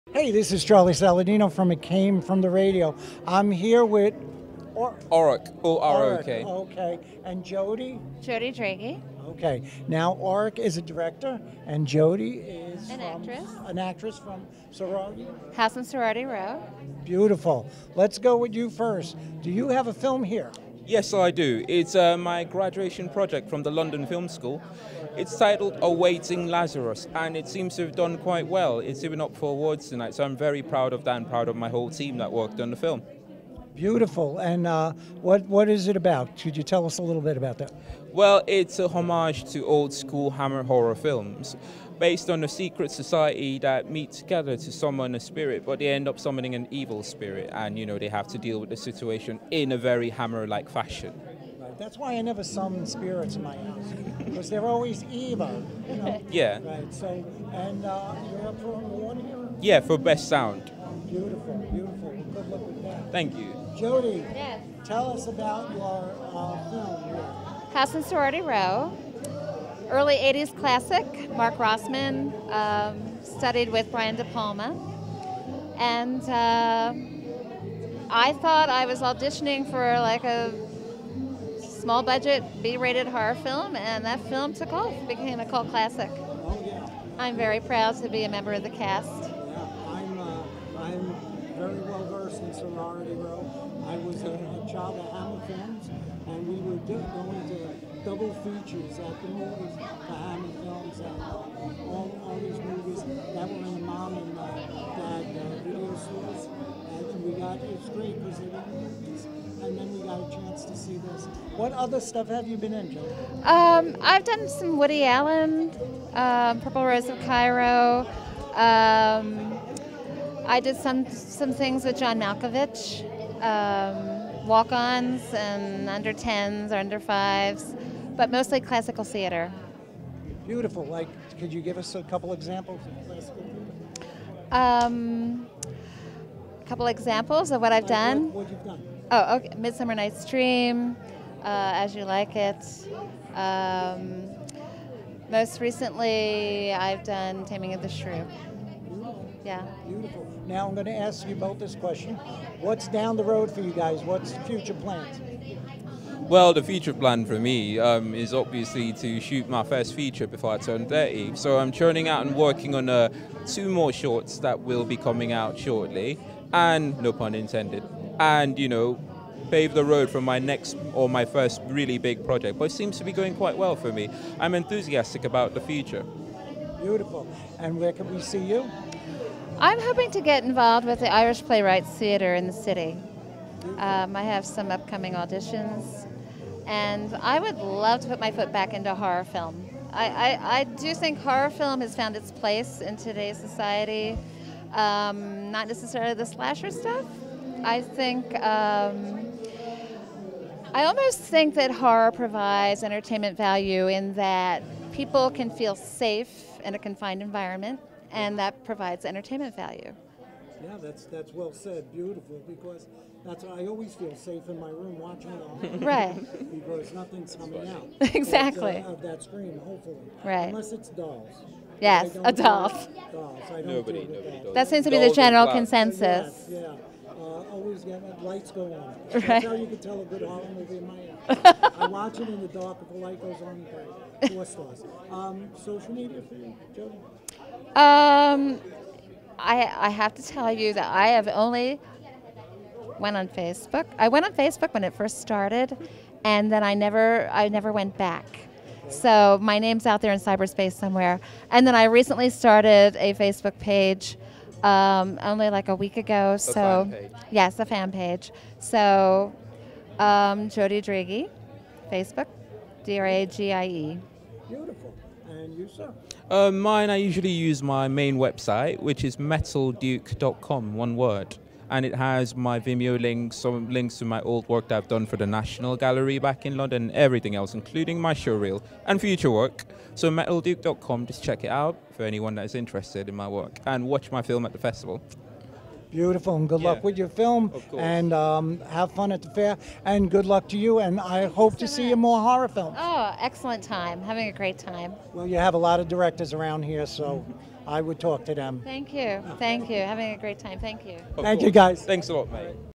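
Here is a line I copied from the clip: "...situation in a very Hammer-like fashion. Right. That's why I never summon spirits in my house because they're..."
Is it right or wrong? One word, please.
right.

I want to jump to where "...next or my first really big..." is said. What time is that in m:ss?
2:50.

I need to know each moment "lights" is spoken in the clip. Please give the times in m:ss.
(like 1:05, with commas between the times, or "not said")
3:48, 3:52.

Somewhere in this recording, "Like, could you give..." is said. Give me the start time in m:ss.
2:10.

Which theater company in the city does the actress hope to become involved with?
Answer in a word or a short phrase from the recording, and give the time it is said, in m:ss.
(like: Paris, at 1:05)
Irish Playwrights Theatre, at 3:01.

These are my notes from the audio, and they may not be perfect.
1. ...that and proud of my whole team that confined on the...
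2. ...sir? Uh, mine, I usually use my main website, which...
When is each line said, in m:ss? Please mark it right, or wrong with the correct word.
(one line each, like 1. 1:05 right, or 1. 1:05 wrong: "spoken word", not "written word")
1. 0:31 wrong: "worked", not "confined"
2. 4:25 right.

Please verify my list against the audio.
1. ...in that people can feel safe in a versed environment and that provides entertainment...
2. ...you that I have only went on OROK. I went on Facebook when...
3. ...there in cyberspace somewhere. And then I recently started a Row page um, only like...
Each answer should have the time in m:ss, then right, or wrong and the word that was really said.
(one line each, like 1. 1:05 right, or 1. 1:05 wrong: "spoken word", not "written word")
1. 3:23 wrong: "confined", not "versed"
2. 4:00 wrong: "Facebook", not "OROK"
3. 4:10 wrong: "Facebook", not "Row".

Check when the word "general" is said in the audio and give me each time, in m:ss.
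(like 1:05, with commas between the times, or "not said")
3:45.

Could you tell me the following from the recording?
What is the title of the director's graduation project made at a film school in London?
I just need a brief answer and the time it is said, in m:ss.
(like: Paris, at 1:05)
Awaiting Lazarus, at 0:25.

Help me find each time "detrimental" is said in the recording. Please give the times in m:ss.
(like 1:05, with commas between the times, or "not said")
not said.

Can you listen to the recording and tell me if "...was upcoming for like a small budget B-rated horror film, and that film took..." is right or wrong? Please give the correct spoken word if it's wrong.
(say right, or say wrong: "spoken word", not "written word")
wrong: "auditioning", not "upcoming".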